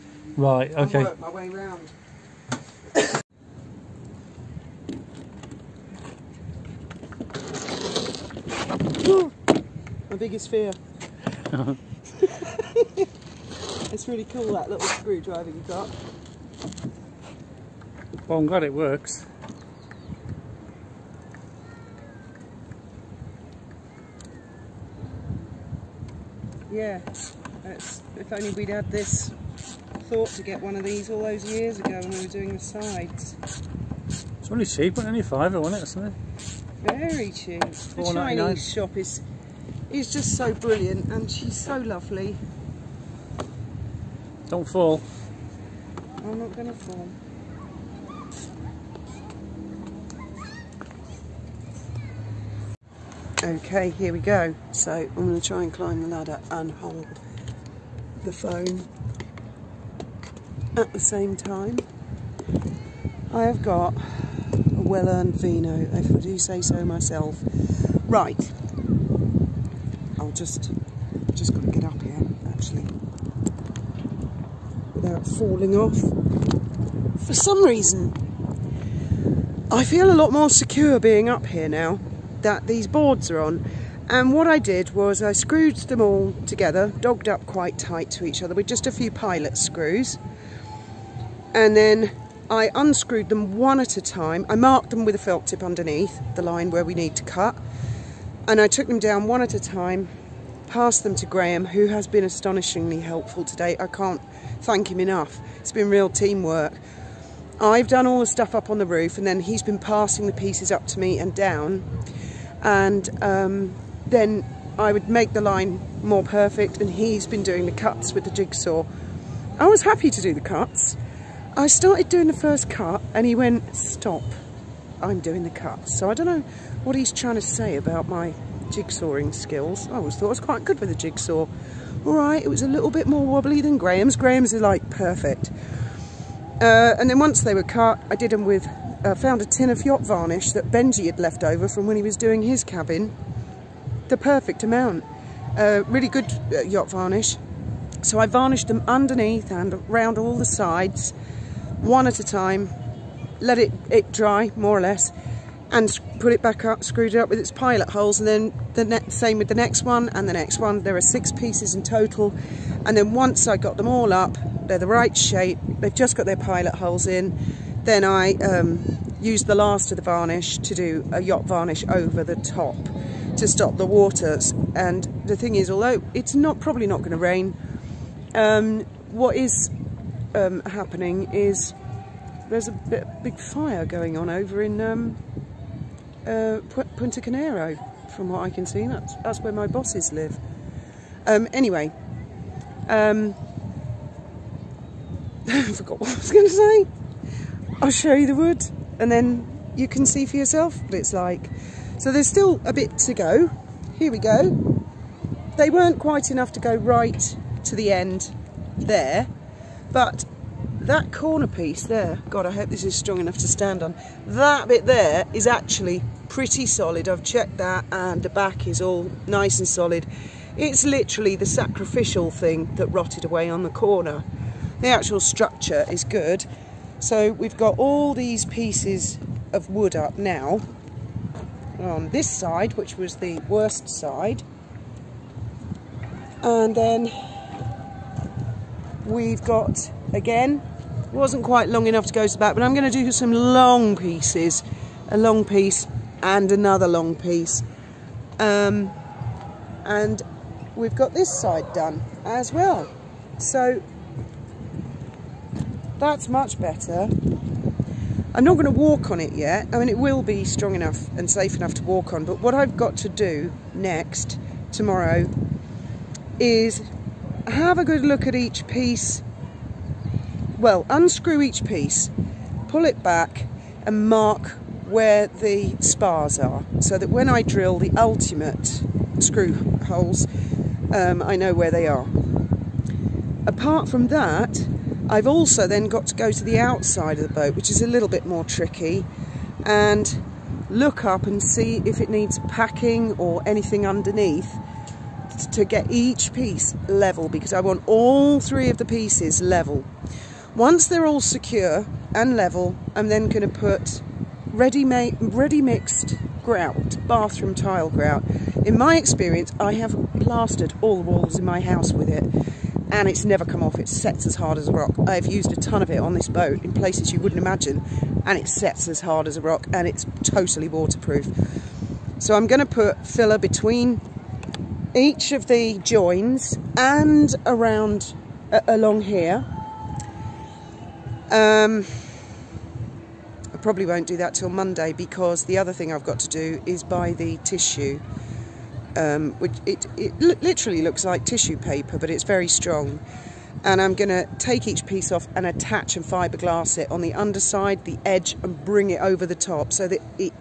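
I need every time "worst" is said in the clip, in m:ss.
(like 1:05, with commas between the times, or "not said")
3:53.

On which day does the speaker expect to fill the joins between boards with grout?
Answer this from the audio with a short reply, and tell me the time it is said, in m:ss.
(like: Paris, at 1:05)
Monday, at 5:34.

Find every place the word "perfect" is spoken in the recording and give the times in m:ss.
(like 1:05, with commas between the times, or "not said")
1:56, 2:14, 2:24.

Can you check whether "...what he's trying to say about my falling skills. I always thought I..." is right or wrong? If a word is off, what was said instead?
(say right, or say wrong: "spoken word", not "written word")
wrong: "jigsawing", not "falling".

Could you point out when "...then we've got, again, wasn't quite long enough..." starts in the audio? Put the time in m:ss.
3:56.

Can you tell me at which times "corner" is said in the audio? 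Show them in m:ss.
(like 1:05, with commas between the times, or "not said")
3:31, 3:43.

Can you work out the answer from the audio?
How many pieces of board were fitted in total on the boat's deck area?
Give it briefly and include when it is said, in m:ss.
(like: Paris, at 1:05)
6, at 2:41.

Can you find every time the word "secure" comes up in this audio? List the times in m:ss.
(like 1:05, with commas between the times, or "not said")
1:20, 5:01.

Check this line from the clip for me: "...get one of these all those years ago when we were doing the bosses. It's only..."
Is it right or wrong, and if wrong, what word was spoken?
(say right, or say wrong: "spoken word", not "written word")
wrong: "sides", not "bosses".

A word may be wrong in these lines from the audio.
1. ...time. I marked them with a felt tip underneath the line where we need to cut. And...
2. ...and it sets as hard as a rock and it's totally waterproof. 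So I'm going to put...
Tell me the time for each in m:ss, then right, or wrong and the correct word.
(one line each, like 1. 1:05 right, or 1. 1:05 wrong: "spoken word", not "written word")
1. 1:34 right
2. 5:18 right.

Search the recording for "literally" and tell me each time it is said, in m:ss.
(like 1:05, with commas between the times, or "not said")
3:40, 5:40.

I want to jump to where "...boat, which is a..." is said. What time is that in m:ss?
4:47.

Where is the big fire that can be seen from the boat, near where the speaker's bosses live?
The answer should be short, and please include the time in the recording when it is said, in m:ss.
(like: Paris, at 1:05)
Punta Carnero, at 3:06.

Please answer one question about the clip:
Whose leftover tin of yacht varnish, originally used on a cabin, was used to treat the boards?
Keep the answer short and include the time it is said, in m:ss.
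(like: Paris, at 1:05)
Benji, at 2:20.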